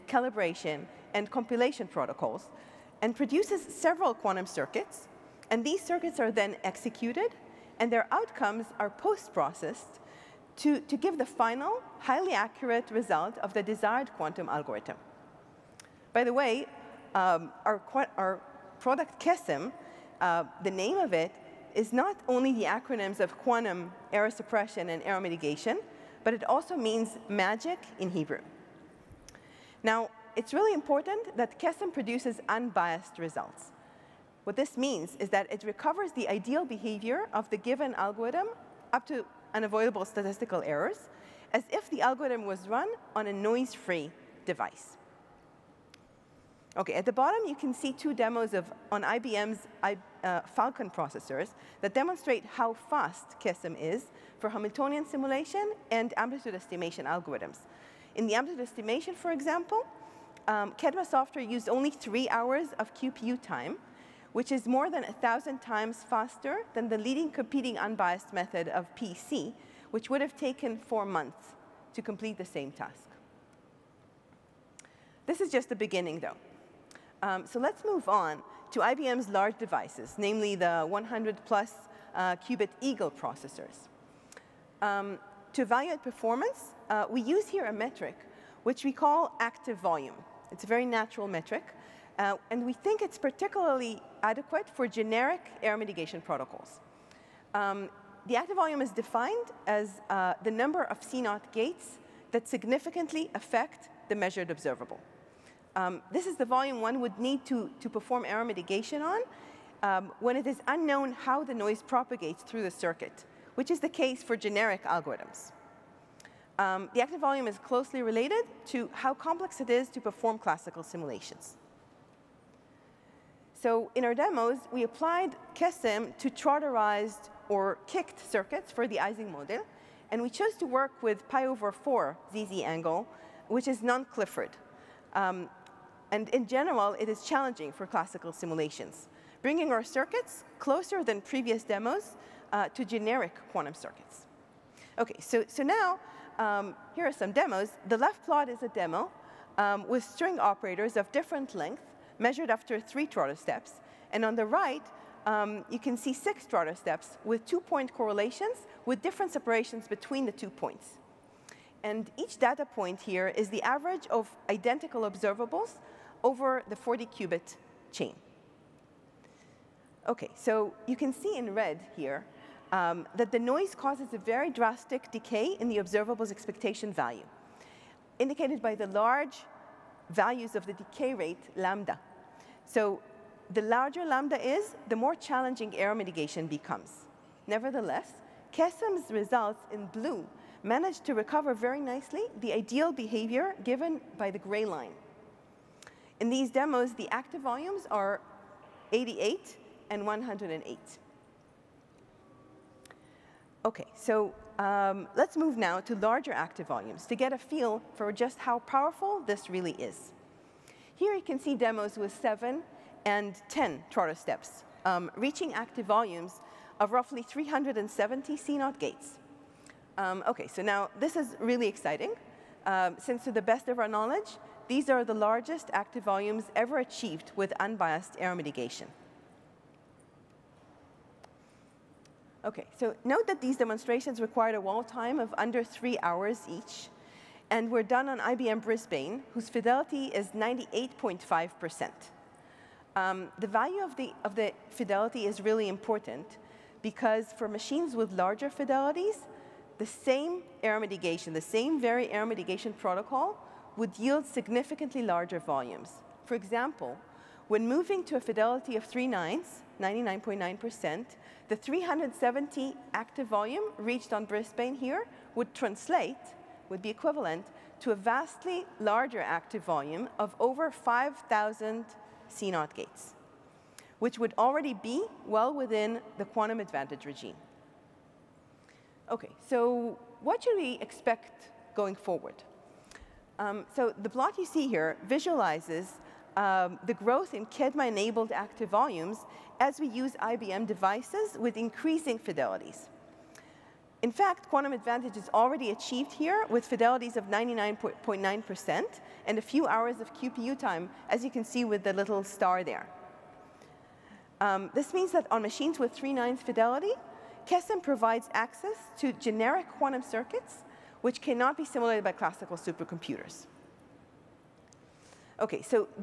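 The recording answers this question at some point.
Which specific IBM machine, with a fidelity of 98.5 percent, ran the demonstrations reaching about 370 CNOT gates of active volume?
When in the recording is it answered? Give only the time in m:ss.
3:58.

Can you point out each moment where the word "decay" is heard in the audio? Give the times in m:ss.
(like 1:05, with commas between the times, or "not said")
2:55, 3:00.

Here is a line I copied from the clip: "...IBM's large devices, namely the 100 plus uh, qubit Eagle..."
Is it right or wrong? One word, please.
right.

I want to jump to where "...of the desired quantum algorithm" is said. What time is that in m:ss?
0:13.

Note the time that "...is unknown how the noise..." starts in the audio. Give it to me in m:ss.
1:50.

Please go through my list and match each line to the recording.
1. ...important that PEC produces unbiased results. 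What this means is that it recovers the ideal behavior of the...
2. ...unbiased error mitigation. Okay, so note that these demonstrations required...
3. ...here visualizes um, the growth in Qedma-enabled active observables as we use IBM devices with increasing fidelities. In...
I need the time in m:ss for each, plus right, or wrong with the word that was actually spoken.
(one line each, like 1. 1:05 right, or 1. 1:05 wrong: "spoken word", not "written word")
1. 0:30 wrong: "QESEM", not "PEC"
2. 3:47 right
3. 4:44 wrong: "volumes", not "observables".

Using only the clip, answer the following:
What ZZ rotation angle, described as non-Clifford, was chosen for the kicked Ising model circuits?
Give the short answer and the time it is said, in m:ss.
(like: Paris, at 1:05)
pi over 4, at 2:11.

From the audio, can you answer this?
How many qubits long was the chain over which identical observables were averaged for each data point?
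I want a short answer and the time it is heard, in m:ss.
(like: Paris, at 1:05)
40, at 2:46.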